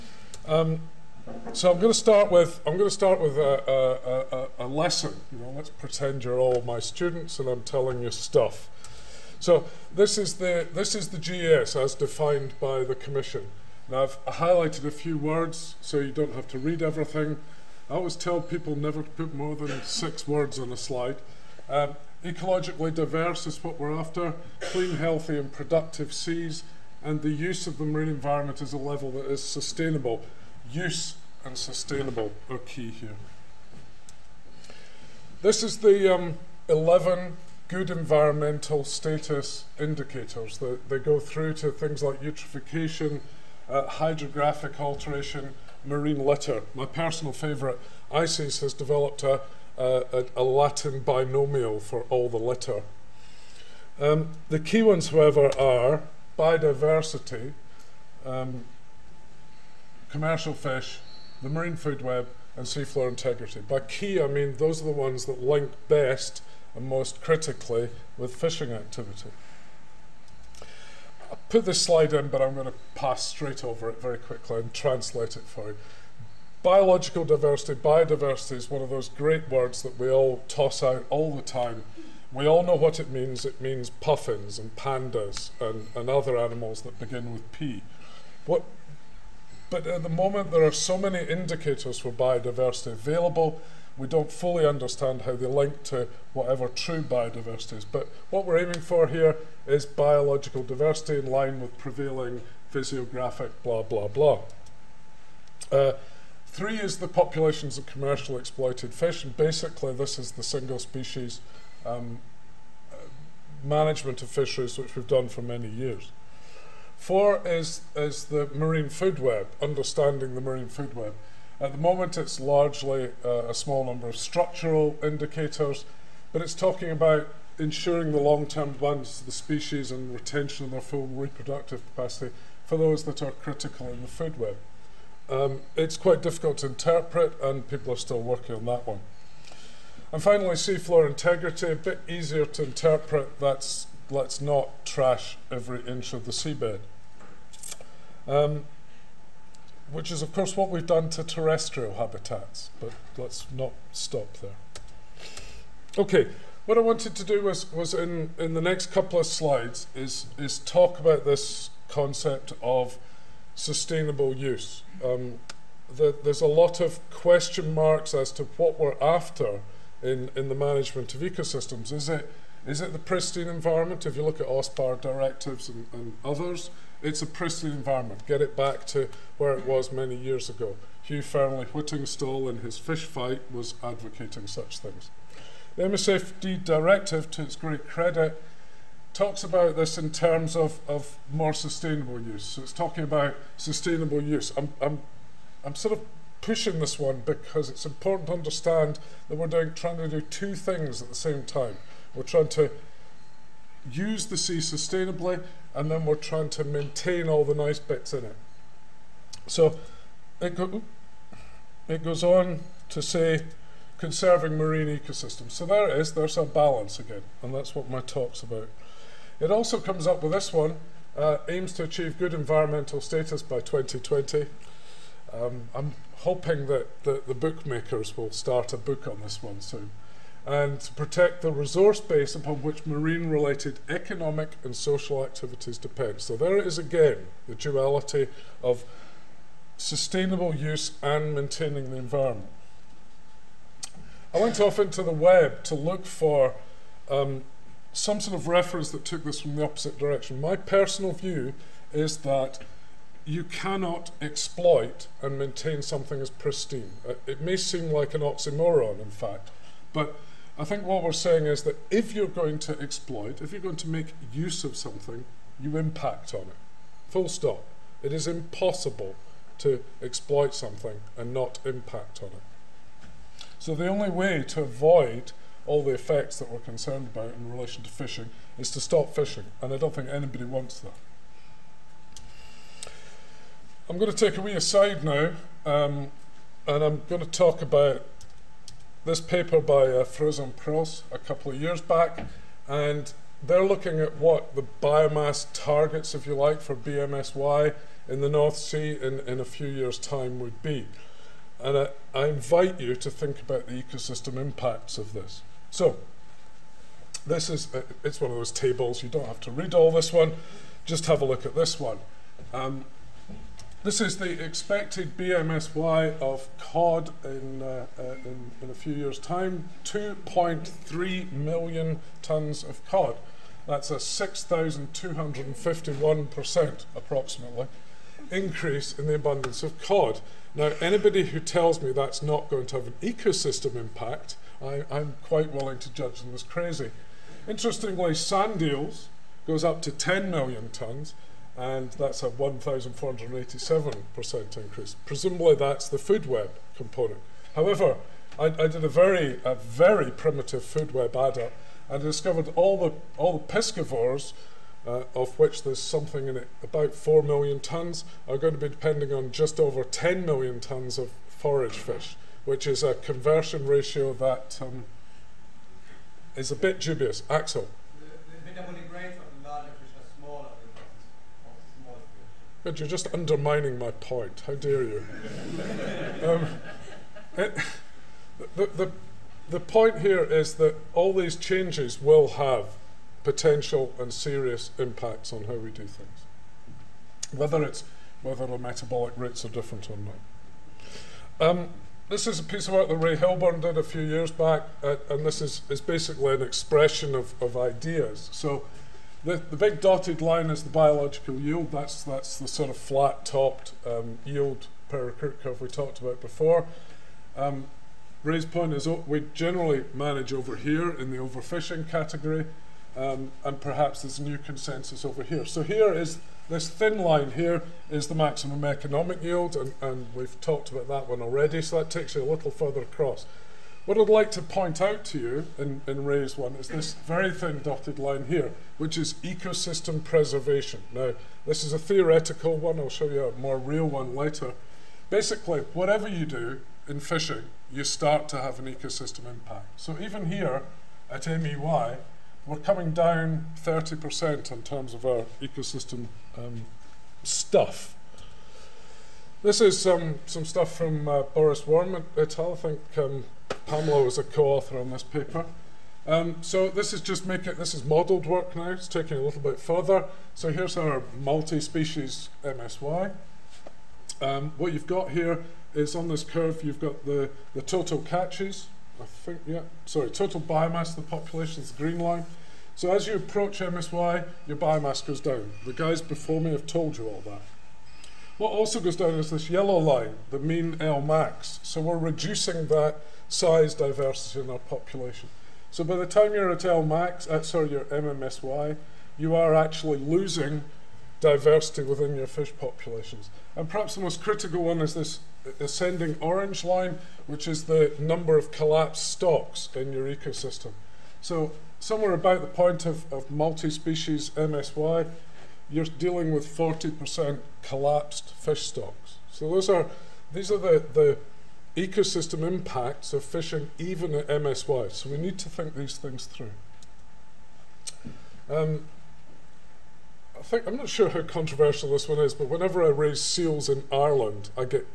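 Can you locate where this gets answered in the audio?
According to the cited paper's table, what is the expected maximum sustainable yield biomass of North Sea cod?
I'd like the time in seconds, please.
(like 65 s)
319 s.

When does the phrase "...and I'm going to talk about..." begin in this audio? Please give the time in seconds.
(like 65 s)
286 s.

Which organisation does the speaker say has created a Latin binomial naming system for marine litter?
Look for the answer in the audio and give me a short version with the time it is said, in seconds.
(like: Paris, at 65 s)
ICES, at 48 s.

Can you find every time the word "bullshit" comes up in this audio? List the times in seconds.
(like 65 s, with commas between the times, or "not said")
not said.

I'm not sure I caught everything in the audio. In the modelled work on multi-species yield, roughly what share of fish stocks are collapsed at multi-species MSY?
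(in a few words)
40%.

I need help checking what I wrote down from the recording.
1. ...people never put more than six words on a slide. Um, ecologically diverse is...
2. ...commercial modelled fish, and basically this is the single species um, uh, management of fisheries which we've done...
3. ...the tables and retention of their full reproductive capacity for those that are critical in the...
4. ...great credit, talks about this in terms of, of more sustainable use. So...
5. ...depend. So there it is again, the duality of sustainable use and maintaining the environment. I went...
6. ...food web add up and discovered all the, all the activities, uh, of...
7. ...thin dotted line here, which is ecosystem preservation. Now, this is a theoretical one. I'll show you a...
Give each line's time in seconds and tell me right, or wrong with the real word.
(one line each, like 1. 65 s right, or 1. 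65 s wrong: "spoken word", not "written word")
1. 18 s right
2. 107 s wrong: "exploited", not "modelled"
3. 129 s wrong: "species", not "tables"
4. 187 s right
5. 235 s right
6. 350 s wrong: "piscivores", not "activities"
7. 427 s right.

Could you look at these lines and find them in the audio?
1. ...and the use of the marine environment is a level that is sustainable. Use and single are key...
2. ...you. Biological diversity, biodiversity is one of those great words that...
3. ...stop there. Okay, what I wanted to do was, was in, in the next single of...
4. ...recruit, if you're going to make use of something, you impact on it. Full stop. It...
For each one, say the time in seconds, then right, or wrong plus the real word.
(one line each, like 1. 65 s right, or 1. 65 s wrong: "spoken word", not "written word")
1. 27 s wrong: "sustainable", not "single"
2. 75 s right
3. 153 s wrong: "couple", not "single"
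4. 262 s wrong: "exploit", not "recruit".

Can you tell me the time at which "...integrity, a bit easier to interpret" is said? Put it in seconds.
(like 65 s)
141 s.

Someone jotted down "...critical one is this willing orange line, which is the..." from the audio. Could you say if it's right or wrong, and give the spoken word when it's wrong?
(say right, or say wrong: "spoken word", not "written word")
wrong: "ascending", not "willing".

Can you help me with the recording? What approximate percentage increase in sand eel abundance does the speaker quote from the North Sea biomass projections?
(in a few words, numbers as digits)
1,487%.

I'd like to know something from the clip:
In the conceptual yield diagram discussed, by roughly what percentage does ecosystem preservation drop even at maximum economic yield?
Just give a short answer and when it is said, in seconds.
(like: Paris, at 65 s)
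30%, at 443 s.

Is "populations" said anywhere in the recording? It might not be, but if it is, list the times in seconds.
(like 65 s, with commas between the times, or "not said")
107 s, 471 s, 484 s, 492 s.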